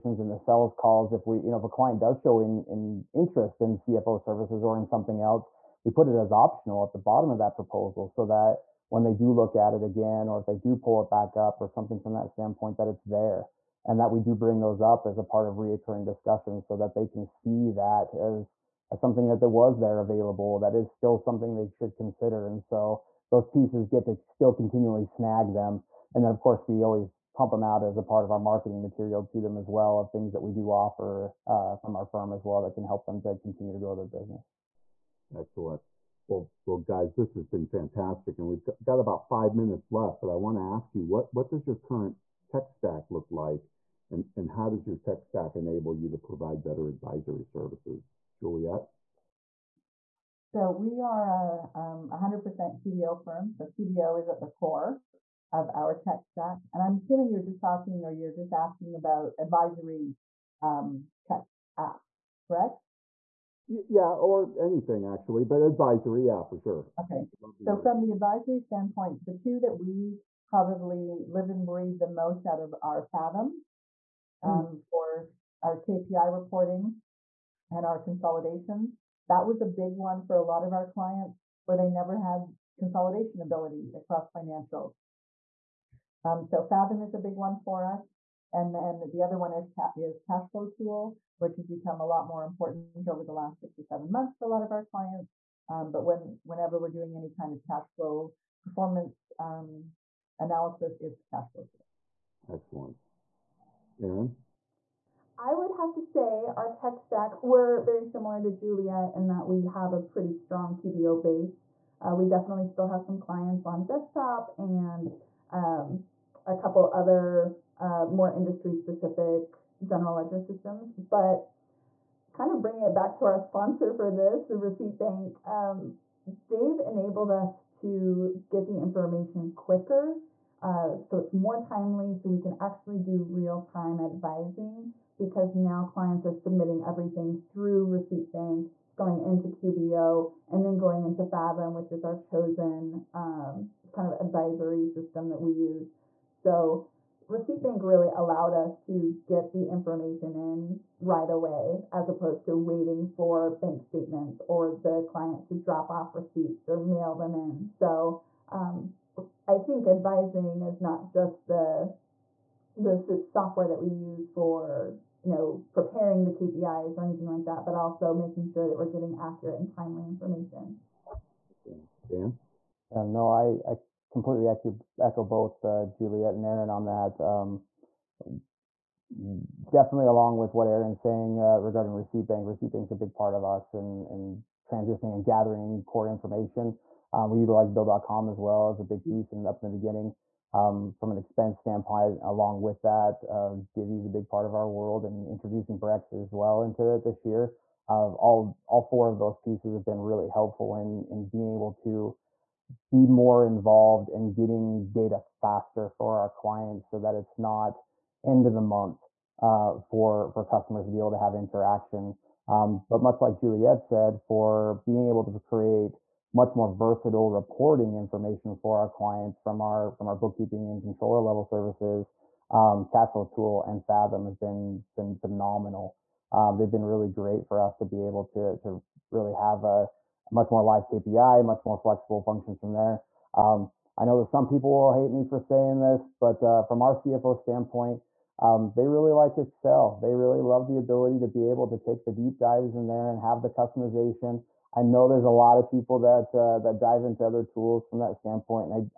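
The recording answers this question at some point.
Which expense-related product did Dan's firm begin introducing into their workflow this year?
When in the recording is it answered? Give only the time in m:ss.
3:15.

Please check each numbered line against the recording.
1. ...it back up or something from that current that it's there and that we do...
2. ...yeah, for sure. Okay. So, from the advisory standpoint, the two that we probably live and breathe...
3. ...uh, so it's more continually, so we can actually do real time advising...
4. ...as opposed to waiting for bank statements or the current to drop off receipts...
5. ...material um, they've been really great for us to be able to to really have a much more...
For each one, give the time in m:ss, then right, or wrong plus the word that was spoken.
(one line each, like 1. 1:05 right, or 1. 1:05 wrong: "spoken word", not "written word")
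1. 0:11 wrong: "standpoint", not "current"
2. 1:06 right
3. 2:10 wrong: "timely", not "continually"
4. 2:31 wrong: "client", not "current"
5. 3:45 wrong: "phenomenal", not "material".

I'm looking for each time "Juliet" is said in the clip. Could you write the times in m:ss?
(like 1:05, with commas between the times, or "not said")
0:48, 1:48, 2:55, 3:33.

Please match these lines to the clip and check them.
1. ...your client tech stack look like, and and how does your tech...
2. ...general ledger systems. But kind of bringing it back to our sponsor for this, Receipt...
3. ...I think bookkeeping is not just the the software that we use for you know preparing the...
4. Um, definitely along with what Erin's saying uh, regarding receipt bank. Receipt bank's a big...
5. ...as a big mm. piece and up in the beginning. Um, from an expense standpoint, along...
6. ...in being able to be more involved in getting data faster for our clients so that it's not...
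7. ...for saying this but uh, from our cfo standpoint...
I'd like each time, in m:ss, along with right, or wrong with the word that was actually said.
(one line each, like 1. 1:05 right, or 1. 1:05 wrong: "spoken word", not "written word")
1. 0:41 wrong: "current", not "client"
2. 1:59 right
3. 2:39 wrong: "advising", not "bookkeeping"
4. 2:57 right
5. 3:08 right
6. 3:21 right
7. 3:55 right.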